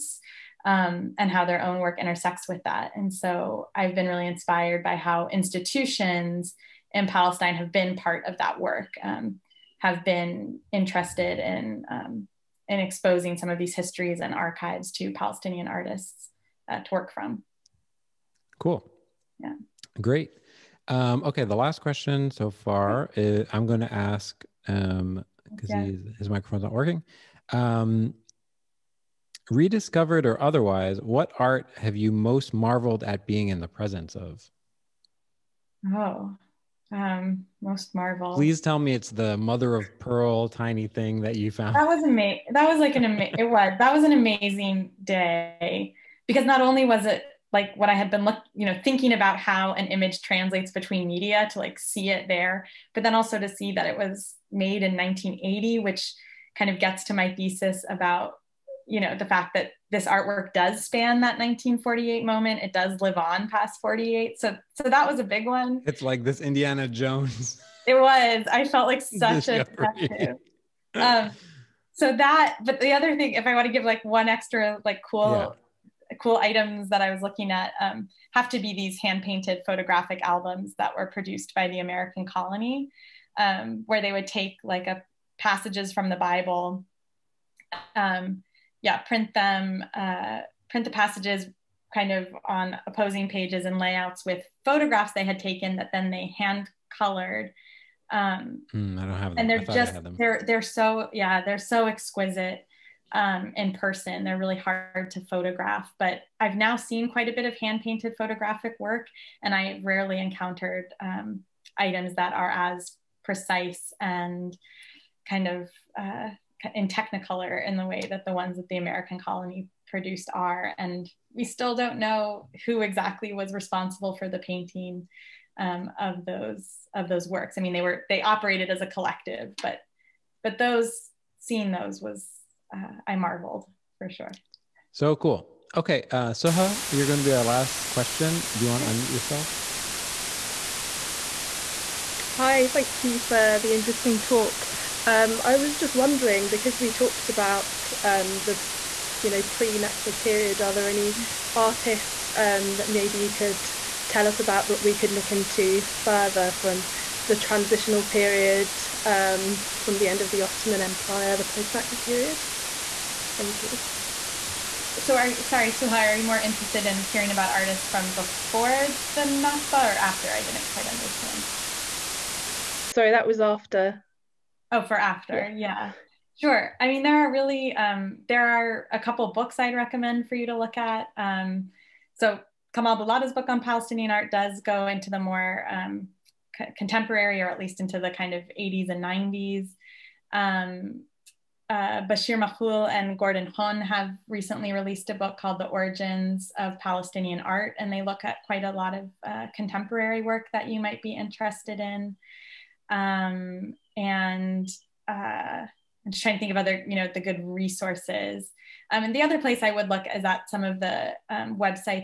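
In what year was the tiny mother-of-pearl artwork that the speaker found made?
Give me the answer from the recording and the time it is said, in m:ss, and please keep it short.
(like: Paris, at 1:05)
1980, at 0:54.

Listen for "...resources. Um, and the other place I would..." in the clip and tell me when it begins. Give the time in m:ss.
3:27.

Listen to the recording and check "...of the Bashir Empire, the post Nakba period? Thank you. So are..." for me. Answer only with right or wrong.
wrong.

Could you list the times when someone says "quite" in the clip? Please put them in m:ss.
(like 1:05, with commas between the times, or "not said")
1:47, 2:50, 3:18.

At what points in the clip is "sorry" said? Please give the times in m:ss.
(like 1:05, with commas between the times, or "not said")
2:45, 2:52.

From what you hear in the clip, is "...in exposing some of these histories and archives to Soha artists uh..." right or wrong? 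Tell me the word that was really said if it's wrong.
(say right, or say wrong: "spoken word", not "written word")
wrong: "Palestinian", not "Soha".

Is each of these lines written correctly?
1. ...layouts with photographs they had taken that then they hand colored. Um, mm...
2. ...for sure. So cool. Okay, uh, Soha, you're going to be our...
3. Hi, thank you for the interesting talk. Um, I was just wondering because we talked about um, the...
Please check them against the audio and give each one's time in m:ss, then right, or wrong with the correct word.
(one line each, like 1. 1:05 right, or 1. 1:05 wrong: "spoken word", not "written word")
1. 1:33 right
2. 2:13 right
3. 2:22 right.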